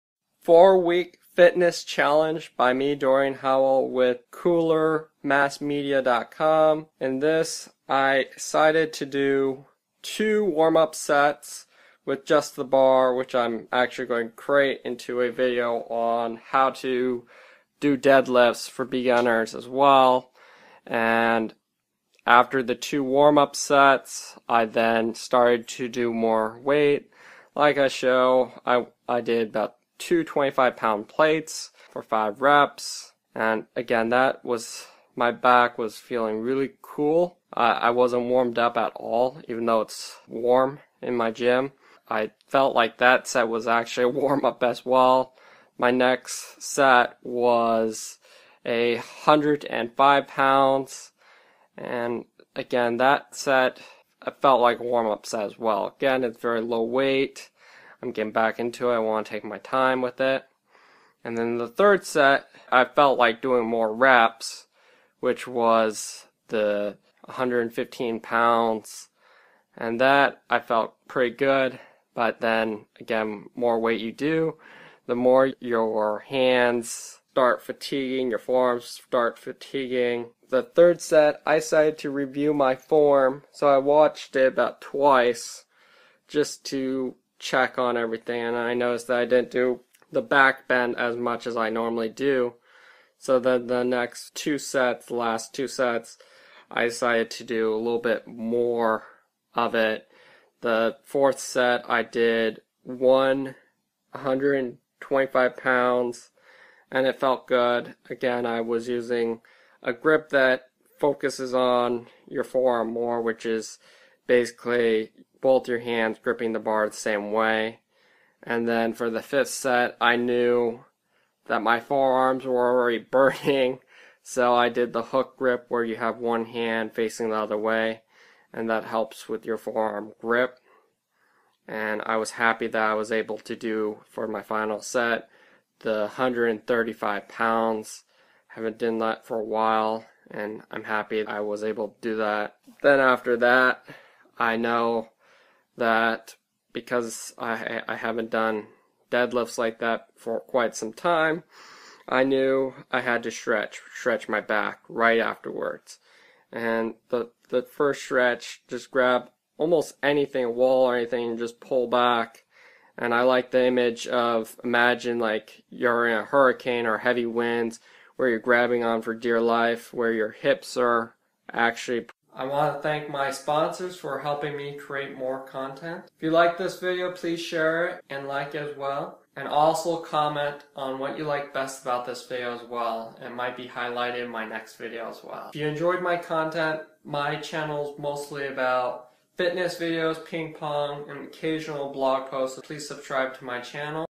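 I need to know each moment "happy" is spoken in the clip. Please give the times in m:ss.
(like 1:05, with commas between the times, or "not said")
2:12, 2:20.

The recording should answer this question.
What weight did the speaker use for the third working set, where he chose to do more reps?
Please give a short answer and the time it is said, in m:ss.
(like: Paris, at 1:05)
115 pounds, at 1:07.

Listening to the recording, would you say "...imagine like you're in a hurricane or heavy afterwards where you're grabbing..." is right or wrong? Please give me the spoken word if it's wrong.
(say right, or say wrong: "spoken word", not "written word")
wrong: "winds", not "afterwards".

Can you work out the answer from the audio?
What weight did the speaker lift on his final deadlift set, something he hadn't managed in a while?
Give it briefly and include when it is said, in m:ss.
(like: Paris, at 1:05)
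135 pounds, at 2:16.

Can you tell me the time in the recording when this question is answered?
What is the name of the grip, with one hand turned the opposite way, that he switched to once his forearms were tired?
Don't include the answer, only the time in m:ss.
2:05.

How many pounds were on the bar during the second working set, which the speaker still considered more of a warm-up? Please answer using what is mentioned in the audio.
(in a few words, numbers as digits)
105 pounds.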